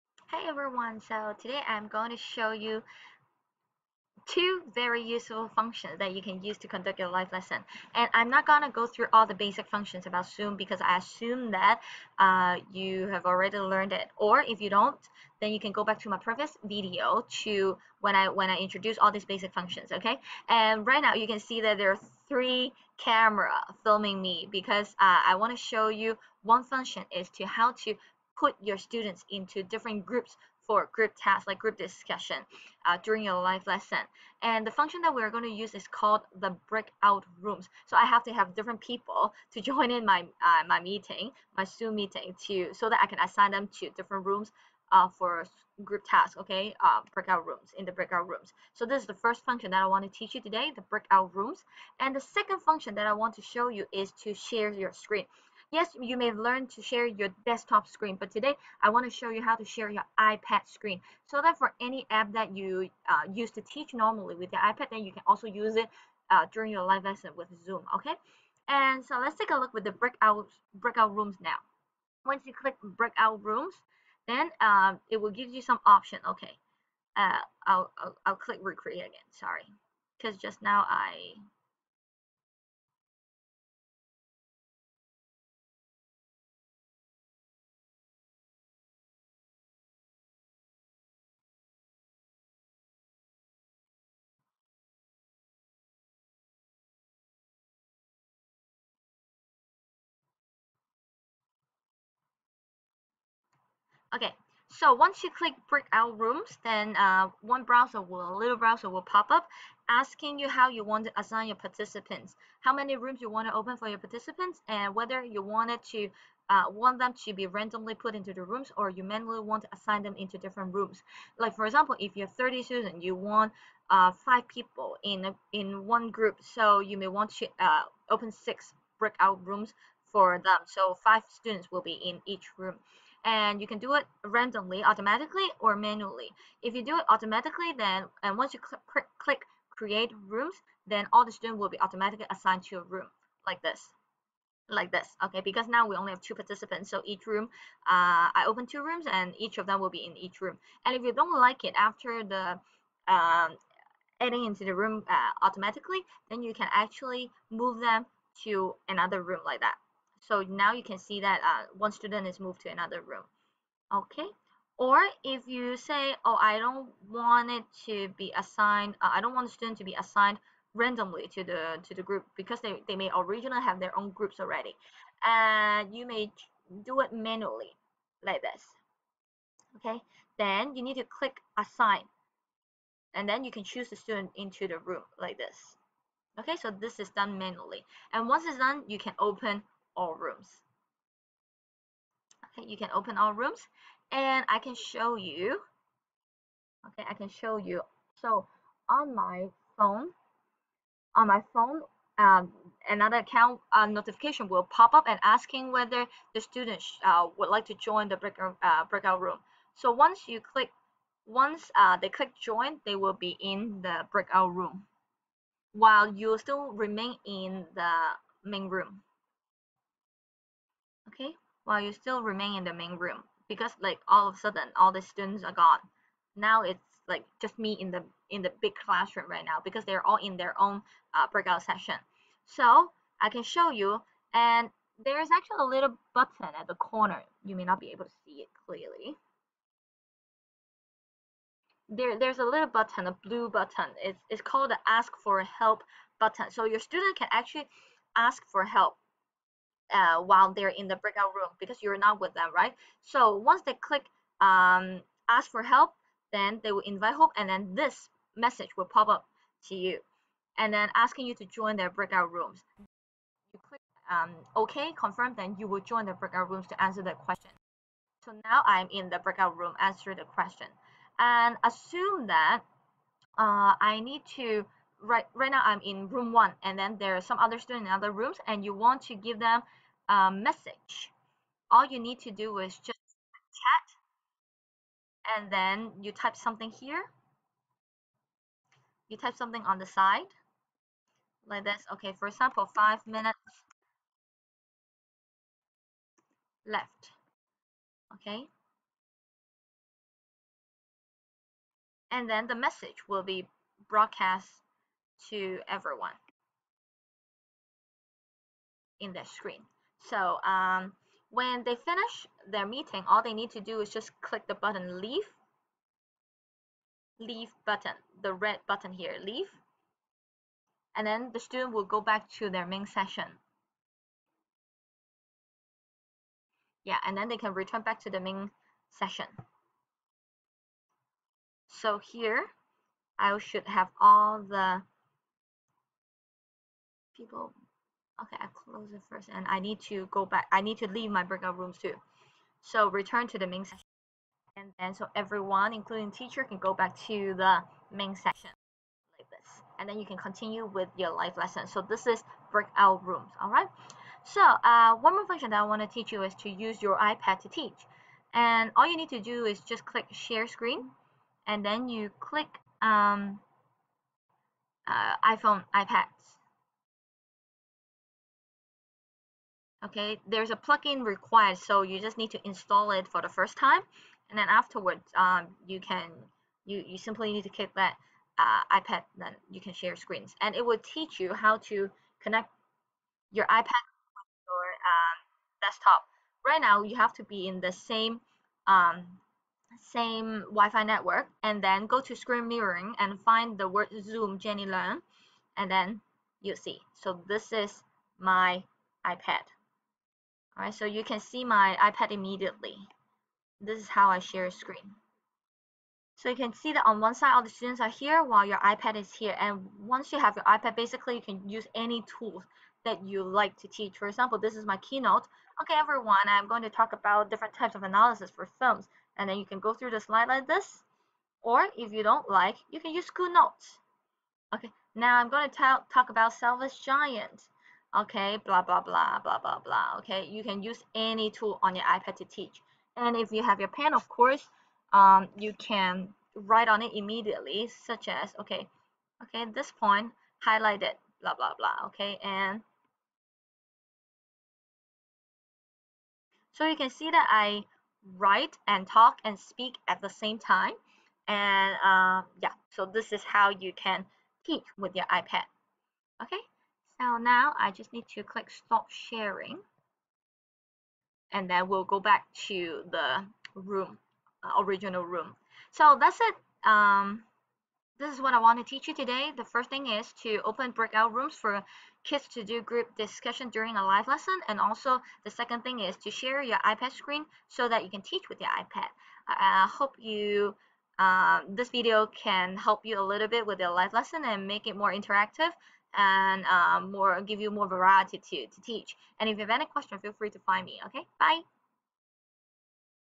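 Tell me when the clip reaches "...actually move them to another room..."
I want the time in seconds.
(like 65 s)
156 s.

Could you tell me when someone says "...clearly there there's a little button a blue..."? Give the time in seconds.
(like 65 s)
238 s.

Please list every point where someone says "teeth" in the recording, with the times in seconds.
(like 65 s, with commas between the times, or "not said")
not said.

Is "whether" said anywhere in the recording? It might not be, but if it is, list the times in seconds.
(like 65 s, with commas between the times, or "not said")
114 s, 205 s.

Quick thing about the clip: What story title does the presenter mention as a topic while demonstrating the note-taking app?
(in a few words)
Selfish Giant.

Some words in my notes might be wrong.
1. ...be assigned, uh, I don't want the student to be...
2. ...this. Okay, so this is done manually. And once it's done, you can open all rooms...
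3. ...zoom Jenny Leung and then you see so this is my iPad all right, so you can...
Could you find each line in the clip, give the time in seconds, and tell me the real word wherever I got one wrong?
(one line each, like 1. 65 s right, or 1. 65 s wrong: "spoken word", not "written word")
1. 168 s right
2. 185 s right
3. 394 s right.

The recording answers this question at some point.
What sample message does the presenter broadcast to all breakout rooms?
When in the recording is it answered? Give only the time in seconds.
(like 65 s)
292 s.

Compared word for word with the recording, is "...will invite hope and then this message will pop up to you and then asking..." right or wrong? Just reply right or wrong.
right.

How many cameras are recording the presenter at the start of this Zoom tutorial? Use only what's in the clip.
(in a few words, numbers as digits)
3.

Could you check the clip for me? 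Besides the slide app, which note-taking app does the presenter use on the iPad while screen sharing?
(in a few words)
GoodNotes.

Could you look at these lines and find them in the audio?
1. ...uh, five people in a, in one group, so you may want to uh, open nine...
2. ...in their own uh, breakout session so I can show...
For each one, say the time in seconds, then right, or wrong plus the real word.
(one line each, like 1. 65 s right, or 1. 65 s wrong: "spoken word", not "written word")
1. 123 s wrong: "six", not "nine"
2. 230 s right.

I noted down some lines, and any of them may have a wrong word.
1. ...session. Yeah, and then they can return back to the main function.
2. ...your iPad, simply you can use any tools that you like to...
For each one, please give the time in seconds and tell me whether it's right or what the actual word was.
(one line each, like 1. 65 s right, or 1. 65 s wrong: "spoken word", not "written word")
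1. 322 s wrong: "session", not "function"
2. 410 s wrong: "basically", not "simply".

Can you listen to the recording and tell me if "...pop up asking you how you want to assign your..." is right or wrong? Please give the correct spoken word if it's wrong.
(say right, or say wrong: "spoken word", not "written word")
right.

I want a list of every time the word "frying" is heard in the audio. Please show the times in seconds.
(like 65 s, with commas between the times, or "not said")
not said.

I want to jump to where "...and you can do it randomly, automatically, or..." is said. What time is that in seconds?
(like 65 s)
133 s.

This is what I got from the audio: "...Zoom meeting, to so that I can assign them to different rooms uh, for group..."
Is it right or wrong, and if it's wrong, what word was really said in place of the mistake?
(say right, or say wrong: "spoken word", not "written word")
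right.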